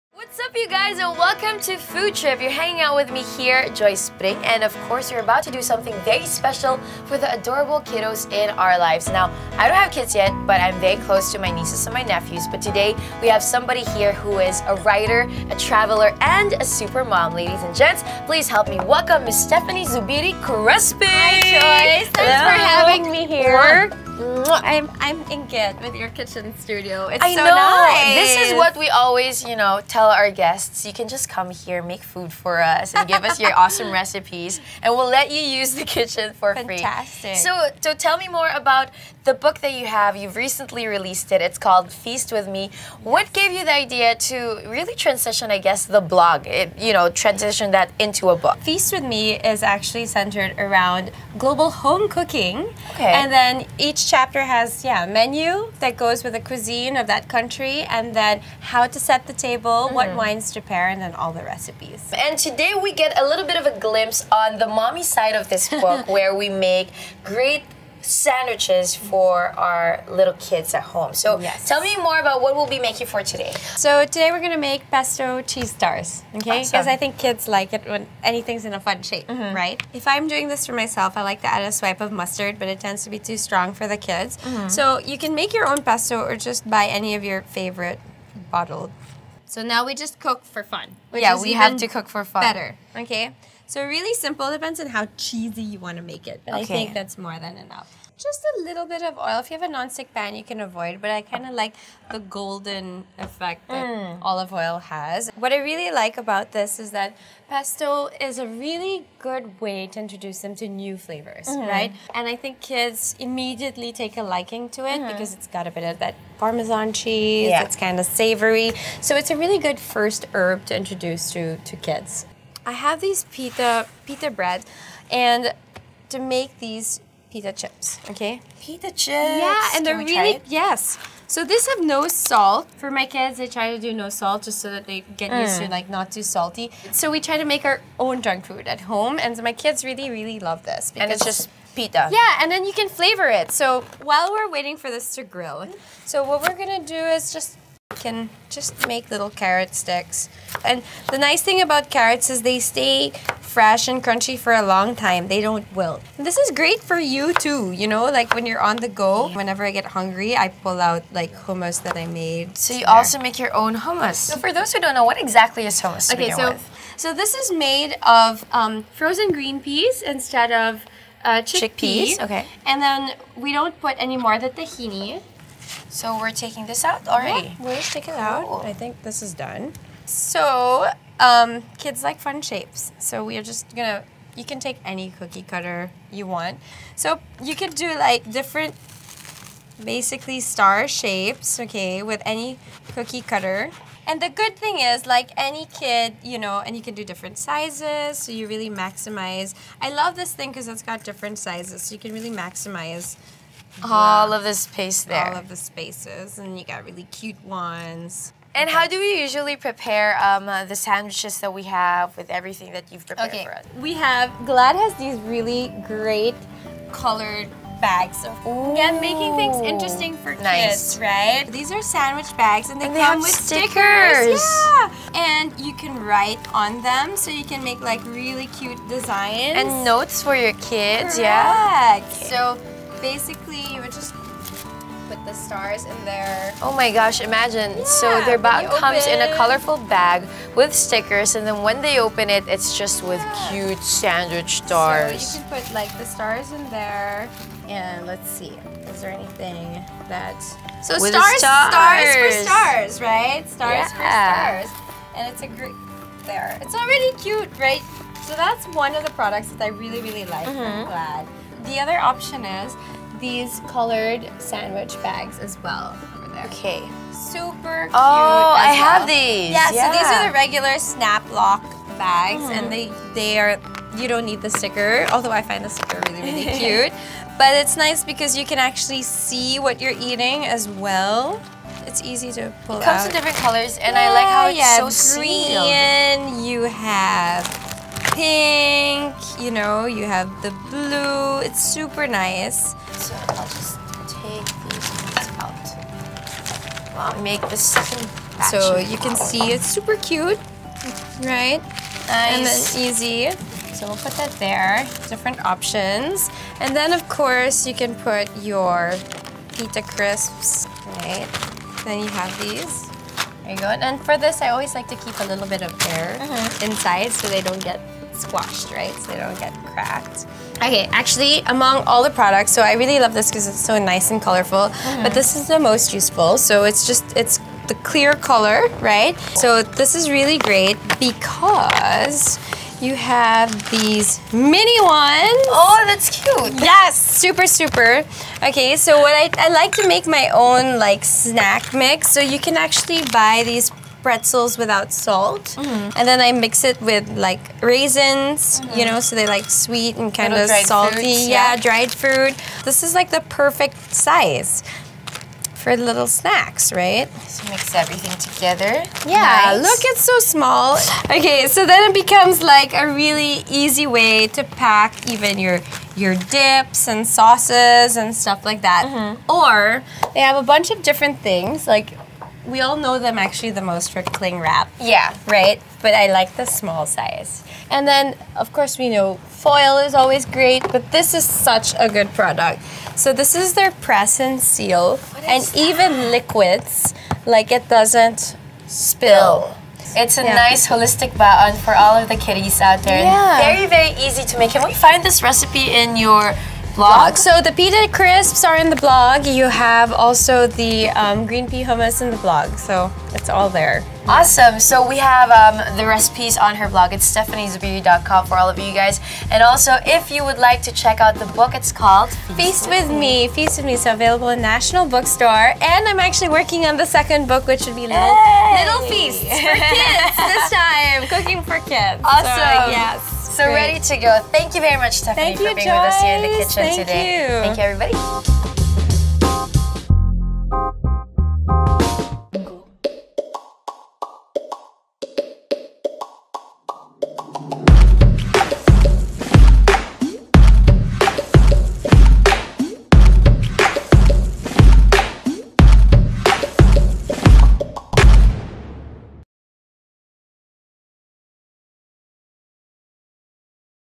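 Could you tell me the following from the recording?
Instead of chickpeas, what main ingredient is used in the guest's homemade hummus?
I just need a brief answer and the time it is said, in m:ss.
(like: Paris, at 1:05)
Frozen green peas, at 2:48.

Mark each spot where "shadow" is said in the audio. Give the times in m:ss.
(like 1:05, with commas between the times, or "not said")
not said.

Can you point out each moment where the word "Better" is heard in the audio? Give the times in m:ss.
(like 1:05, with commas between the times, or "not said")
1:32.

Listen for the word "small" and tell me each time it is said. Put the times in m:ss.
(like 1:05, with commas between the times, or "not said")
6:00, 6:16.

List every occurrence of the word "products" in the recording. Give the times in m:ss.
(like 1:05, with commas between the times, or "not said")
4:19, 5:22, 6:22.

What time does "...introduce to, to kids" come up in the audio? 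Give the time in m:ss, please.
2:00.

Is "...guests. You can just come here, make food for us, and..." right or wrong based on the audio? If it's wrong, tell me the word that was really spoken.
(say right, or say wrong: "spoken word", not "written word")
right.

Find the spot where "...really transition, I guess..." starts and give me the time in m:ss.
0:44.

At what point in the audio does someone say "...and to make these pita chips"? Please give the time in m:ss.
2:05.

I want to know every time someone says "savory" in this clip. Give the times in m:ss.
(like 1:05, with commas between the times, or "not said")
1:58.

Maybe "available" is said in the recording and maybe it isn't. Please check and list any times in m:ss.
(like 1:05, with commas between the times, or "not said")
6:53.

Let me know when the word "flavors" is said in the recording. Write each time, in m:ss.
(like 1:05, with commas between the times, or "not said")
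1:51, 2:22.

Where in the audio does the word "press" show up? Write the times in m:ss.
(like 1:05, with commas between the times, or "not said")
6:23.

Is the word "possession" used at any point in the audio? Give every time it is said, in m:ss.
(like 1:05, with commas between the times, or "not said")
not said.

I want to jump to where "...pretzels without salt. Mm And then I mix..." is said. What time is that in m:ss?
5:44.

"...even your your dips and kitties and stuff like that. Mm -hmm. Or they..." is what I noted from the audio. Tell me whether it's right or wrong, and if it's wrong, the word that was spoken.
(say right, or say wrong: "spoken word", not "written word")
wrong: "sauces", not "kitties".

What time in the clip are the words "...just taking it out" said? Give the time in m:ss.
2:57.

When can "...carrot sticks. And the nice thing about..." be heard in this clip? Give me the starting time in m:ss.
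2:29.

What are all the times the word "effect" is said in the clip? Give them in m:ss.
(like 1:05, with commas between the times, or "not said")
1:43.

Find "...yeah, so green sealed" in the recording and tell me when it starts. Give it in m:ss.
4:44.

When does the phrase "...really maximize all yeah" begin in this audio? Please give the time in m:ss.
3:22.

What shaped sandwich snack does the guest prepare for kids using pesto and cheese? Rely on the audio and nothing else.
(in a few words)
Pesto cheese stars.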